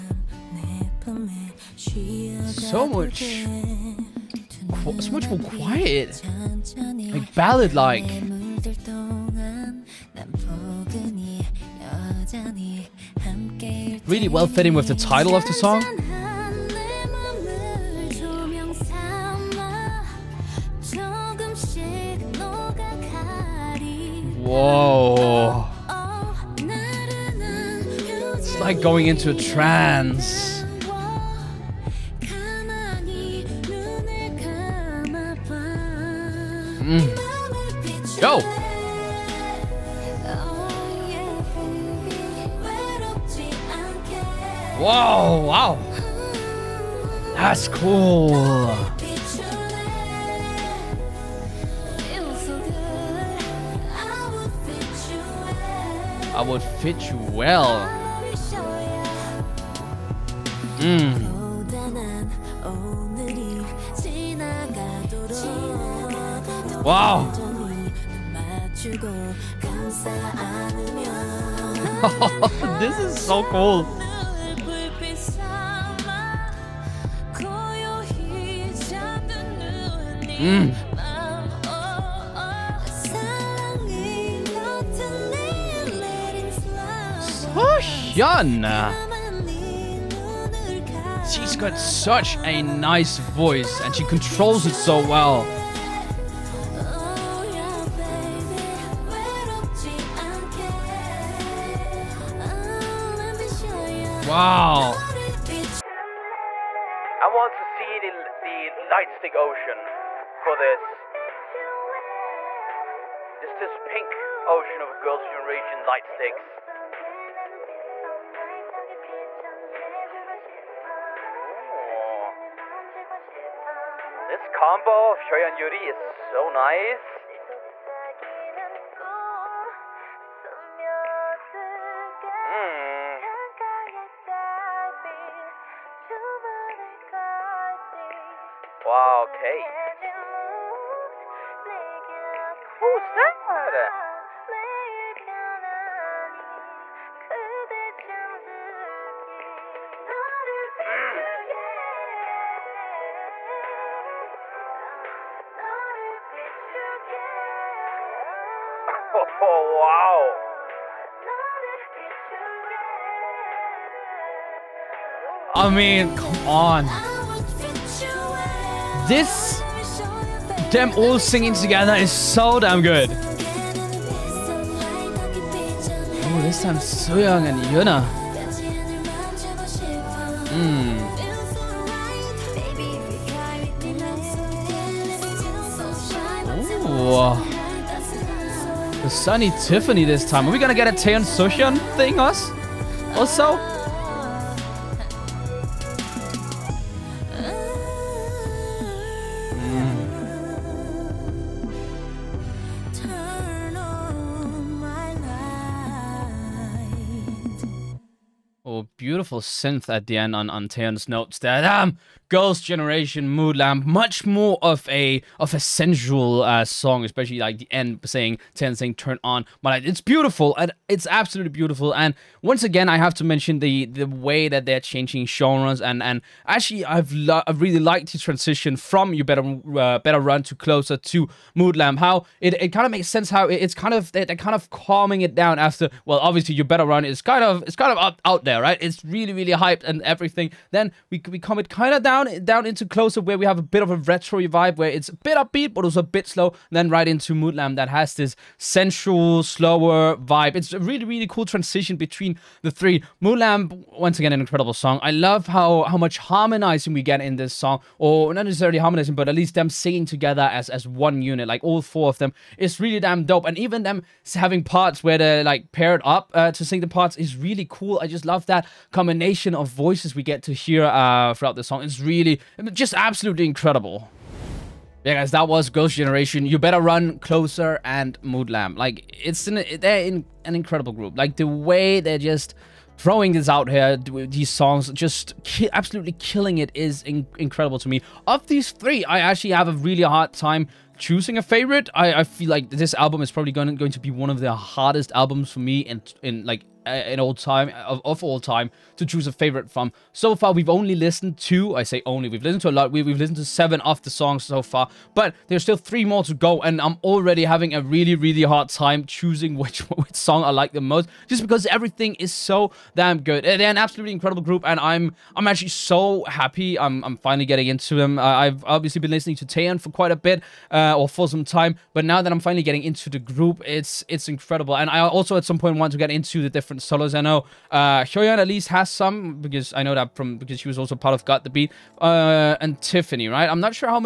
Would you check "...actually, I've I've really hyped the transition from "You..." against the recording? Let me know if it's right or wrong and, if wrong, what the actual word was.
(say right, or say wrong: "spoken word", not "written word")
wrong: "liked", not "hyped".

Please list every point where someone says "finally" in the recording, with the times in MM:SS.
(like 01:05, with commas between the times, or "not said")
05:17, 05:22.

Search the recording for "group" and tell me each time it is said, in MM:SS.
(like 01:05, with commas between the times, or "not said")
04:40, 05:14, 05:23.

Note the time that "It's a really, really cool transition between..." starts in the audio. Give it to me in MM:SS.
04:10.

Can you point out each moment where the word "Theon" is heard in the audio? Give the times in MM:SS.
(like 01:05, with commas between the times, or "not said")
03:38.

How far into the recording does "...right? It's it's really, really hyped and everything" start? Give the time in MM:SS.
03:58.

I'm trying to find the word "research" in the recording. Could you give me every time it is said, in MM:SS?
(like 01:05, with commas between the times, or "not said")
not said.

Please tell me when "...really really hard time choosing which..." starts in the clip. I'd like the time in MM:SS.
05:07.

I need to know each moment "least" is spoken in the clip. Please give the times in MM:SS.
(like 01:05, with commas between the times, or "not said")
04:19, 05:28.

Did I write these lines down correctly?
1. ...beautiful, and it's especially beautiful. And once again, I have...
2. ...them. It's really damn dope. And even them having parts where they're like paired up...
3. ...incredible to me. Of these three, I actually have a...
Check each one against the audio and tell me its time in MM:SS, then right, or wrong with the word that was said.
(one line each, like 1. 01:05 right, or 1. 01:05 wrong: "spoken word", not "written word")
1. 03:40 wrong: "absolutely", not "especially"
2. 04:22 right
3. 04:47 right.